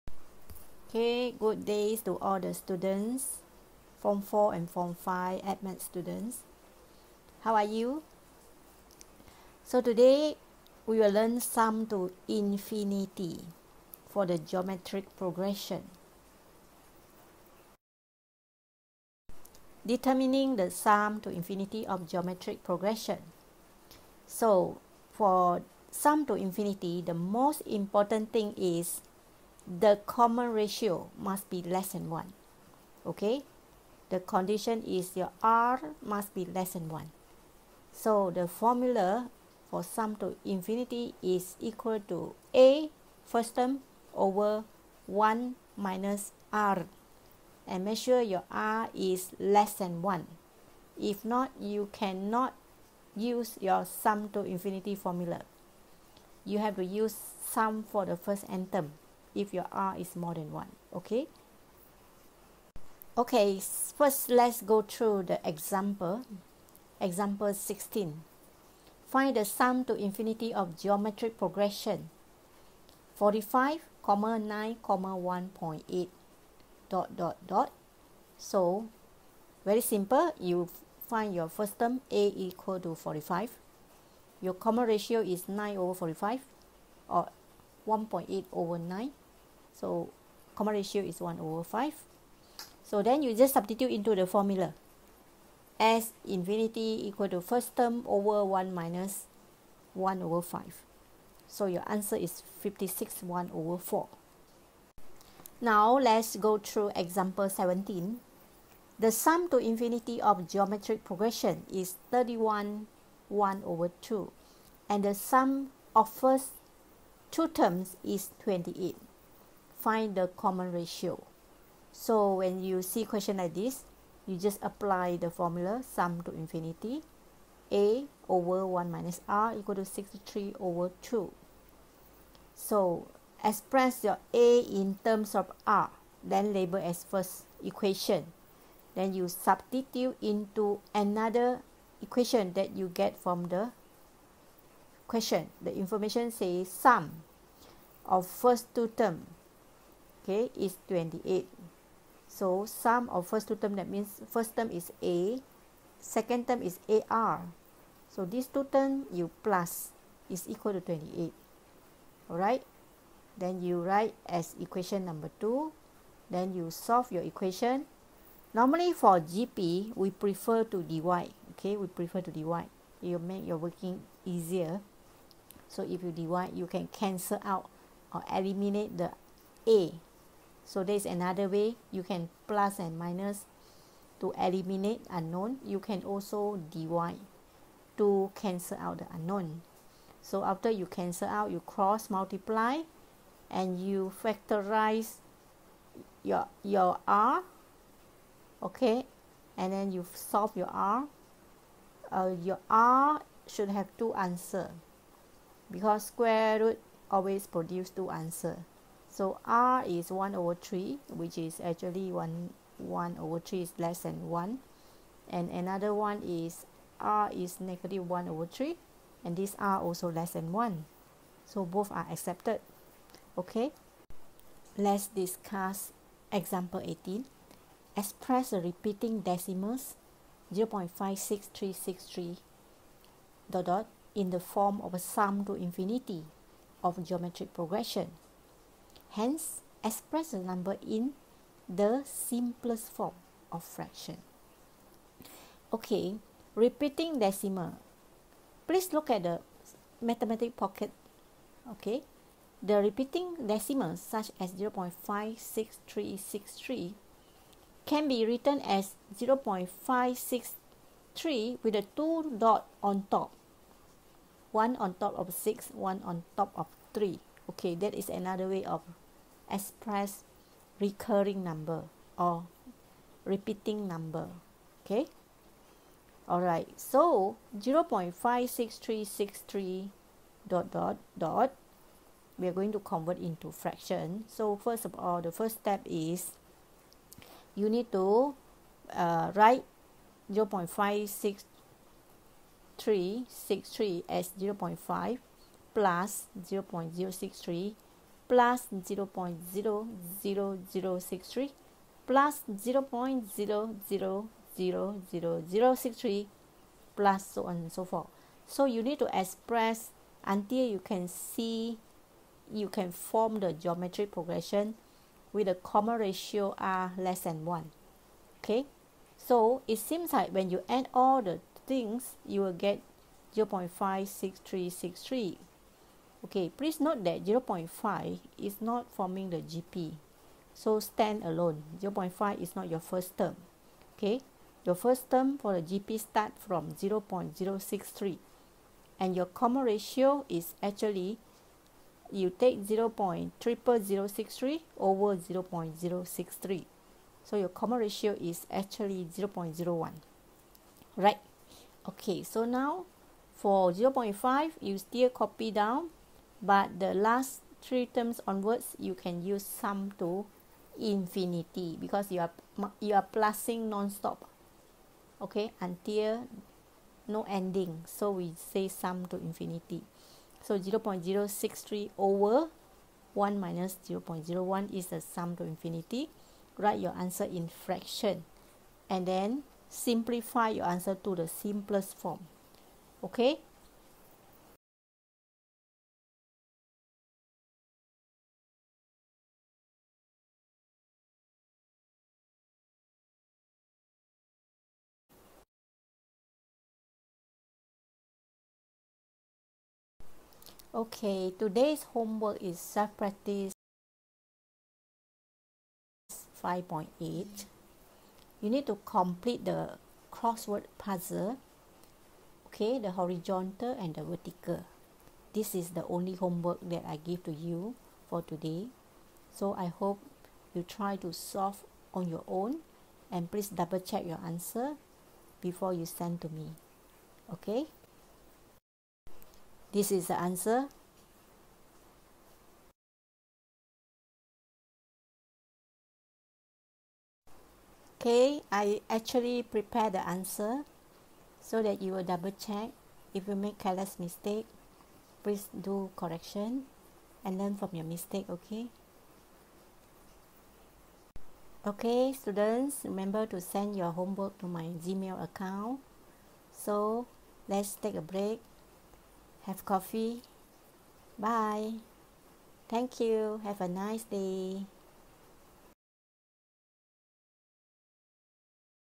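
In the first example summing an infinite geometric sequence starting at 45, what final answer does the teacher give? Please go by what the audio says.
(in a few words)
56 1/4.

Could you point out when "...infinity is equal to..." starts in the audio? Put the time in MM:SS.
00:40.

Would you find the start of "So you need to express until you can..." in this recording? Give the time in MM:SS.
05:08.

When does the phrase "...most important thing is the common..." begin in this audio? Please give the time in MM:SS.
00:27.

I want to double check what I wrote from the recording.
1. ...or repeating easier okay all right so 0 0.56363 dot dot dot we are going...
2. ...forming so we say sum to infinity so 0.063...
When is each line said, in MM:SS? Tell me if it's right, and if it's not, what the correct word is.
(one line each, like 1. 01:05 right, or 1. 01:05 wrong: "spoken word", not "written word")
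1. 04:32 wrong: "number", not "easier"
2. 06:07 wrong: "ending", not "forming".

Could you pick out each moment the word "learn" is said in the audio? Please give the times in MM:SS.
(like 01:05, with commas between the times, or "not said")
00:11, 07:27.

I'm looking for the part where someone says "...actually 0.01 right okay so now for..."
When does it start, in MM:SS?
05:48.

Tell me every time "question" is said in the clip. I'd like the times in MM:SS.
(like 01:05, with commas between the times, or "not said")
02:03, 02:25.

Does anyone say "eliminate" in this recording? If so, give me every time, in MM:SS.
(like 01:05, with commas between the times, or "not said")
02:58, 03:04.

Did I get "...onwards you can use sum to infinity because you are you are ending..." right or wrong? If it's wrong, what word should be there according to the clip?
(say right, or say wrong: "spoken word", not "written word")
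wrong: "plusing", not "ending".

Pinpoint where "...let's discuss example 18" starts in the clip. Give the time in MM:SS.
03:44.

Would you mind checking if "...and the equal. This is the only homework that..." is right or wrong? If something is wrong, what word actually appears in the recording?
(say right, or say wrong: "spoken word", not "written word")
wrong: "vertical", not "equal".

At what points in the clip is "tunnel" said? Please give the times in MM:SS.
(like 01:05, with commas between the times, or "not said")
not said.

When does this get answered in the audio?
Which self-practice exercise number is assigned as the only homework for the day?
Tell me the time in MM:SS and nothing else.
06:46.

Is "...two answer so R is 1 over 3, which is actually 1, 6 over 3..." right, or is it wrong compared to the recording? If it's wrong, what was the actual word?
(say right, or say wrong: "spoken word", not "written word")
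wrong: "1", not "6".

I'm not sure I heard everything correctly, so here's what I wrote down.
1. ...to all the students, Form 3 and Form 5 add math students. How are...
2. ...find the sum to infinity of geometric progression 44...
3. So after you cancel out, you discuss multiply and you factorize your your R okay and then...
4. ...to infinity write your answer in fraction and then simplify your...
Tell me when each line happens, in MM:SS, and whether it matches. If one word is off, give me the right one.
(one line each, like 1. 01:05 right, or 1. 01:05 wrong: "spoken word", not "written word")
1. 00:02 wrong: "4", not "3"
2. 01:09 wrong: "45", not "44"
3. 03:10 wrong: "cross", not "discuss"
4. 06:15 right.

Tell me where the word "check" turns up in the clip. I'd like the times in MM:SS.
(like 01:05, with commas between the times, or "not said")
07:03, 07:22.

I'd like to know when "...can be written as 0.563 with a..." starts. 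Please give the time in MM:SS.
04:17.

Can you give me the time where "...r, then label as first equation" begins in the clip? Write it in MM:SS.
02:15.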